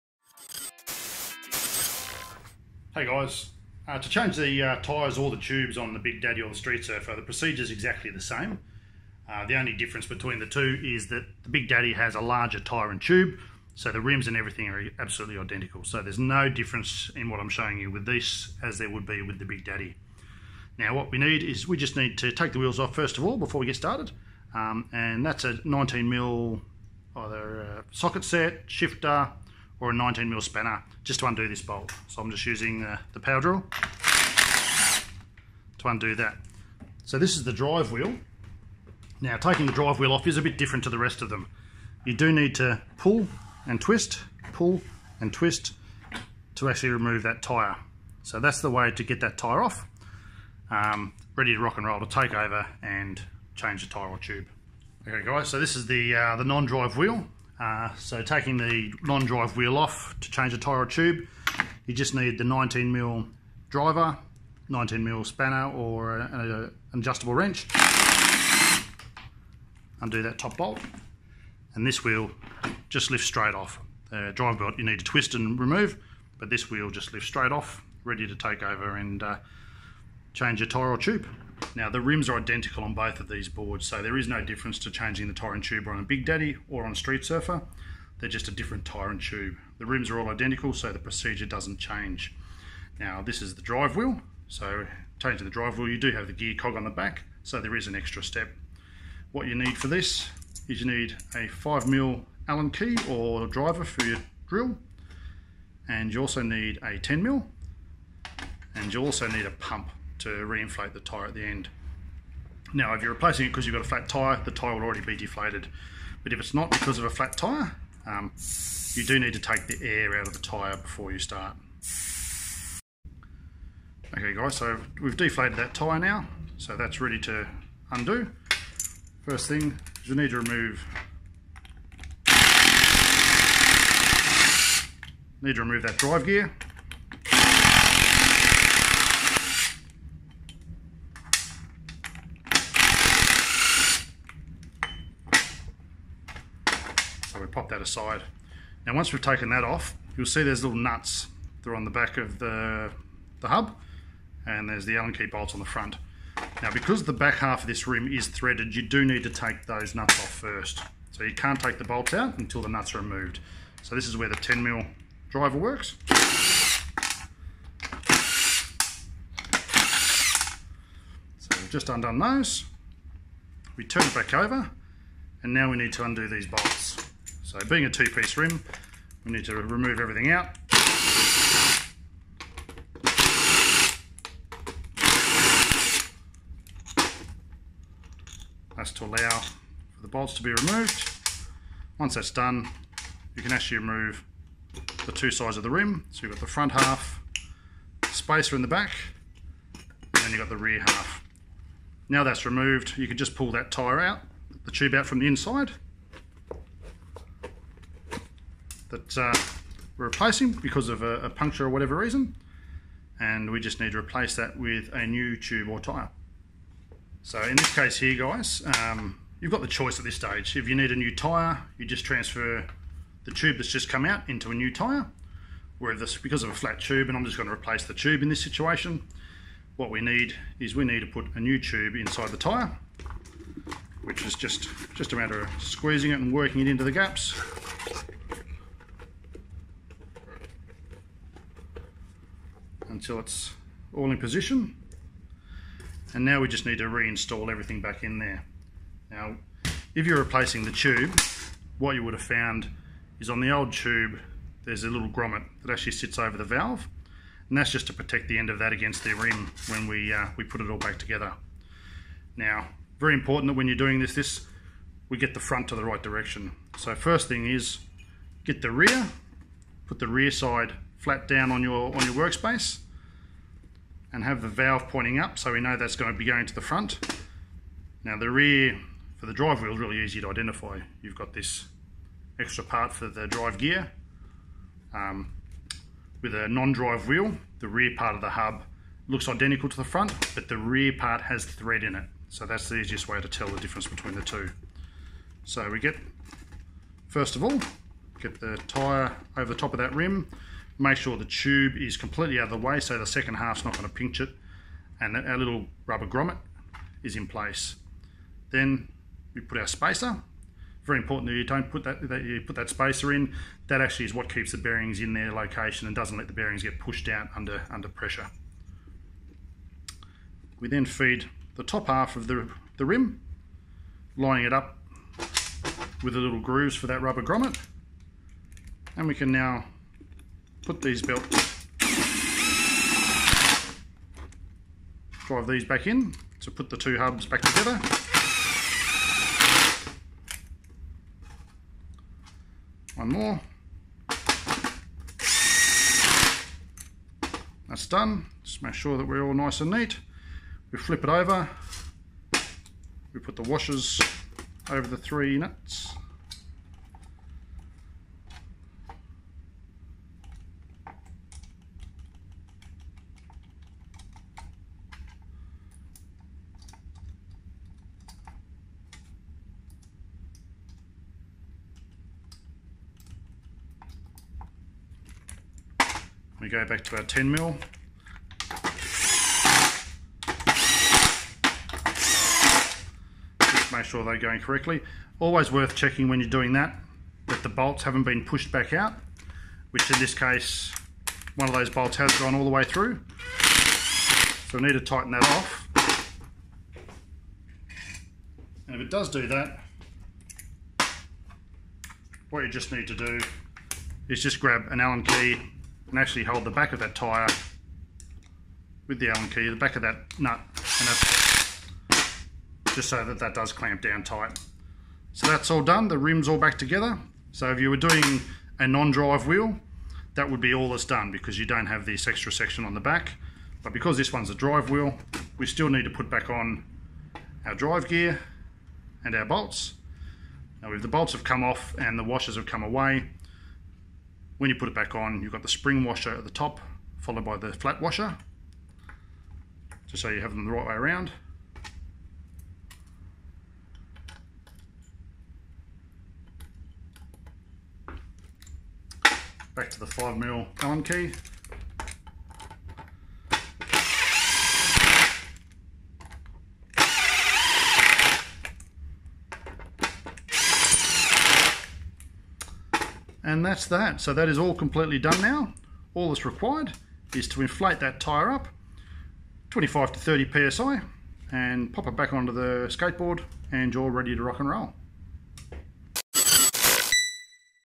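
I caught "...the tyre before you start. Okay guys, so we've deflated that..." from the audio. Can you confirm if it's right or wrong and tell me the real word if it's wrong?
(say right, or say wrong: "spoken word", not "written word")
right.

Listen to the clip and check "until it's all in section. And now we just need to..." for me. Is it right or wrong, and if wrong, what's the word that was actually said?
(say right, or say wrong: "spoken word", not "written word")
wrong: "position", not "section".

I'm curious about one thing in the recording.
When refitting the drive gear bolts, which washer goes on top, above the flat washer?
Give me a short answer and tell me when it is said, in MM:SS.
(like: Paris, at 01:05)
spring washer, at 07:15.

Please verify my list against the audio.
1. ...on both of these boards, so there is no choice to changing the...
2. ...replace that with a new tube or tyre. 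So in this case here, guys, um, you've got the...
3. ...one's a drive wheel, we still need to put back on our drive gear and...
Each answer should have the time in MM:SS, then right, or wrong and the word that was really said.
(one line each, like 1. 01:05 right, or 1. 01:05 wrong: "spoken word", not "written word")
1. 01:22 wrong: "difference", not "choice"
2. 03:33 right
3. 07:04 right.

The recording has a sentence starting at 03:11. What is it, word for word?
Once that's done, you can actually remove the two sides of the rim.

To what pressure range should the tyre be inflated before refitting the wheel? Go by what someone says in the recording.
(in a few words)
25 to 30 psi.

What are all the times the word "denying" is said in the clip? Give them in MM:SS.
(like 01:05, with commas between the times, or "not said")
not said.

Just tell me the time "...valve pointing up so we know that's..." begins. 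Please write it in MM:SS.
04:34.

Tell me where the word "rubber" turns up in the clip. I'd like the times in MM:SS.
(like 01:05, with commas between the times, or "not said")
05:05, 05:27.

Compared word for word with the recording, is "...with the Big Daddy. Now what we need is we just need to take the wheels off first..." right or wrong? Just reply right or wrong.
right.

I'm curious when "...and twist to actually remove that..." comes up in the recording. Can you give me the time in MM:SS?
00:45.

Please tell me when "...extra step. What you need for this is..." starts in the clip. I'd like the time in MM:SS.
01:37.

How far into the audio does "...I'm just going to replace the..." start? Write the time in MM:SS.
03:47.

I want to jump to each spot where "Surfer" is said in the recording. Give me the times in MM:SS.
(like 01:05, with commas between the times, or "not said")
00:06, 01:27.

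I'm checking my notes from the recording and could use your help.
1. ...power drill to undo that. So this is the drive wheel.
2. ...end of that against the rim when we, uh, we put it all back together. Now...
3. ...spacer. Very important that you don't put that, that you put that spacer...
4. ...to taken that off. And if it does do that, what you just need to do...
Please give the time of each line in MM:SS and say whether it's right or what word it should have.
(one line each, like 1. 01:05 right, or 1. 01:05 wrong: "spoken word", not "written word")
1. 00:33 right
2. 04:18 right
3. 05:09 right
4. 06:34 wrong: "tighten", not "taken".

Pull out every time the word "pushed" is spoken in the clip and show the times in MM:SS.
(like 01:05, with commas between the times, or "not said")
05:16, 06:28.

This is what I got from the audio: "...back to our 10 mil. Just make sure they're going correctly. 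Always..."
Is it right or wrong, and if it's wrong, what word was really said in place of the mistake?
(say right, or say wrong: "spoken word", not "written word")
right.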